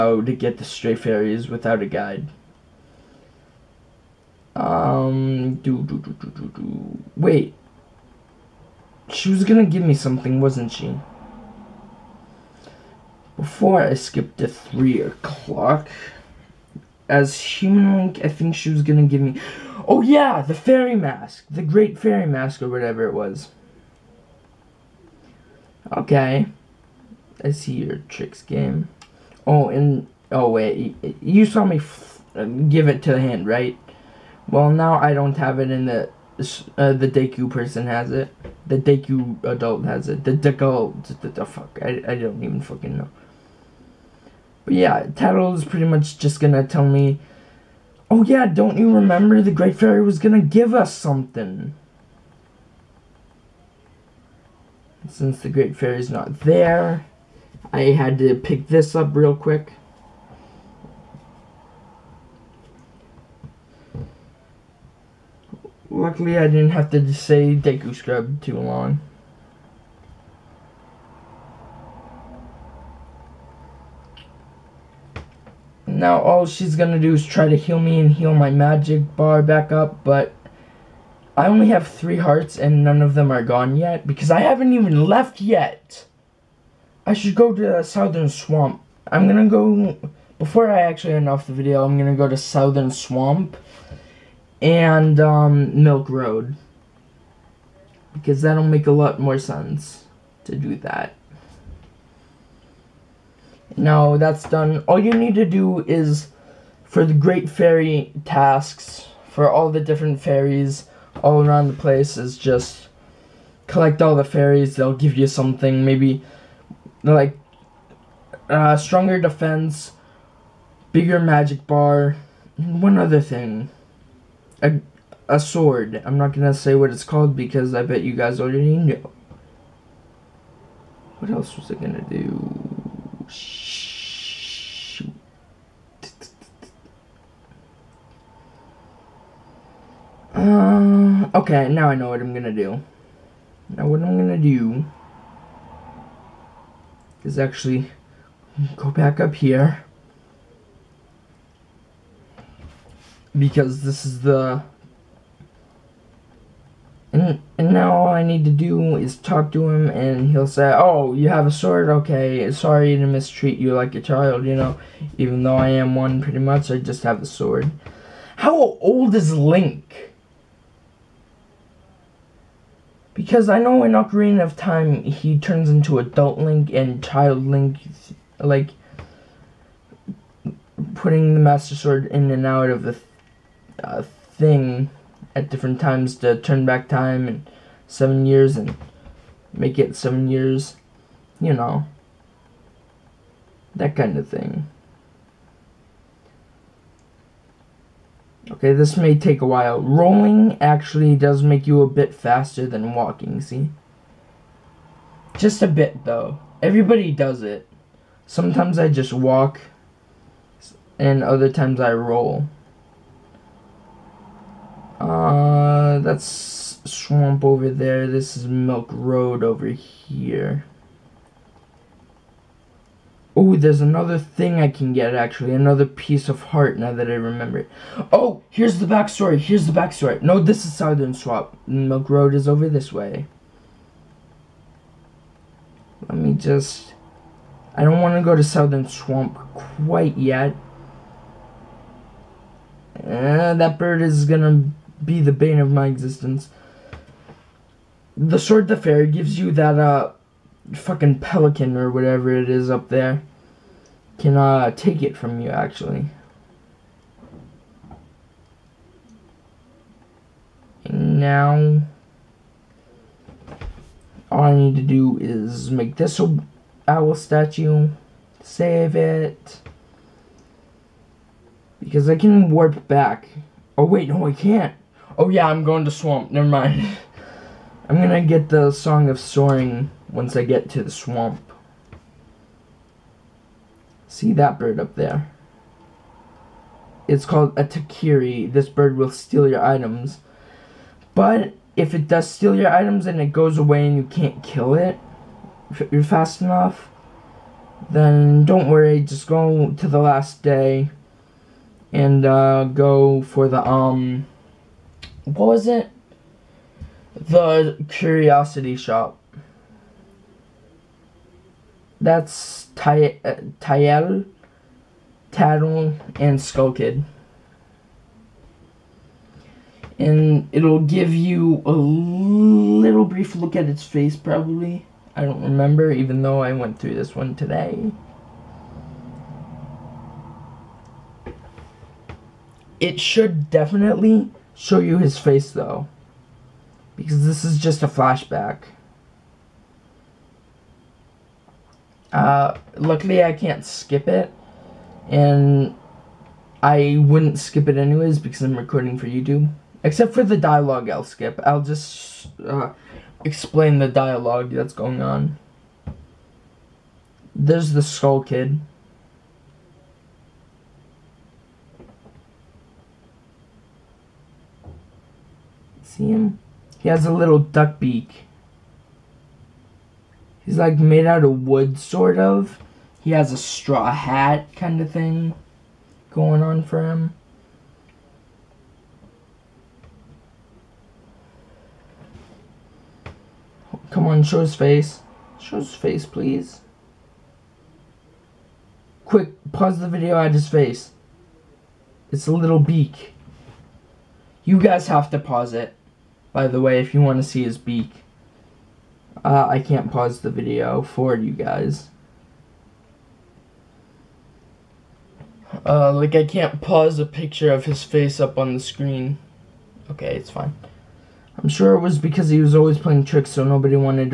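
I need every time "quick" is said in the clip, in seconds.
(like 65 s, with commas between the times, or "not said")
59 s, 389 s.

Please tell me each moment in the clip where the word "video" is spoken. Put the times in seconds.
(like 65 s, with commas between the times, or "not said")
91 s, 389 s, 400 s.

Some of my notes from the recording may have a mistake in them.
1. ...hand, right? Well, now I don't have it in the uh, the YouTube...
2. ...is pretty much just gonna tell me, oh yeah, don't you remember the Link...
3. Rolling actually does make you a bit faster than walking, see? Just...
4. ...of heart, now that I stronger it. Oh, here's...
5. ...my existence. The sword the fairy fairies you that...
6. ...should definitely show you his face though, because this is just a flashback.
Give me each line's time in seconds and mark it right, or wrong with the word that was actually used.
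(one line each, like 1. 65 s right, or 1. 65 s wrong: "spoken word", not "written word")
1. 33 s wrong: "Deku", not "YouTube"
2. 45 s wrong: "Great", not "Link"
3. 199 s right
4. 226 s wrong: "remember", not "stronger"
5. 245 s wrong: "gives", not "fairies"
6. 332 s right.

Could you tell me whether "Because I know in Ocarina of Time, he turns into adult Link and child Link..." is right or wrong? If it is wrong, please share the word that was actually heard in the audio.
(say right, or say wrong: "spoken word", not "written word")
right.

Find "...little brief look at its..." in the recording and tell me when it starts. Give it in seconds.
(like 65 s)
321 s.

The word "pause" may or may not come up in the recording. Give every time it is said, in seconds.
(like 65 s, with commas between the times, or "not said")
389 s, 395 s, 399 s, 406 s.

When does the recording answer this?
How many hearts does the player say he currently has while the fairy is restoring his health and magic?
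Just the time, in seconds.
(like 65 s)
81 s.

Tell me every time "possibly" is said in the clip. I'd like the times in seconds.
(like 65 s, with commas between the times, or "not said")
not said.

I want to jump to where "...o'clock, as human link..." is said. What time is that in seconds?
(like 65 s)
15 s.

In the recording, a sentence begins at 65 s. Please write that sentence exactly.
Luckily I didn't have to say Deku Scrub too long.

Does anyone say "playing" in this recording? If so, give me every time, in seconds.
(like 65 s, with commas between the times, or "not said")
412 s.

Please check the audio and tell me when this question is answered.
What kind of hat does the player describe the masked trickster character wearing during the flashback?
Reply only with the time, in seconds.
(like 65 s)
373 s.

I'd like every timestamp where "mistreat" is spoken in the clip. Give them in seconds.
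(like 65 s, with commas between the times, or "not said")
163 s.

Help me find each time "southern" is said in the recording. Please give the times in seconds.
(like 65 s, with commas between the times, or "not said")
87 s, 92 s, 230 s, 238 s.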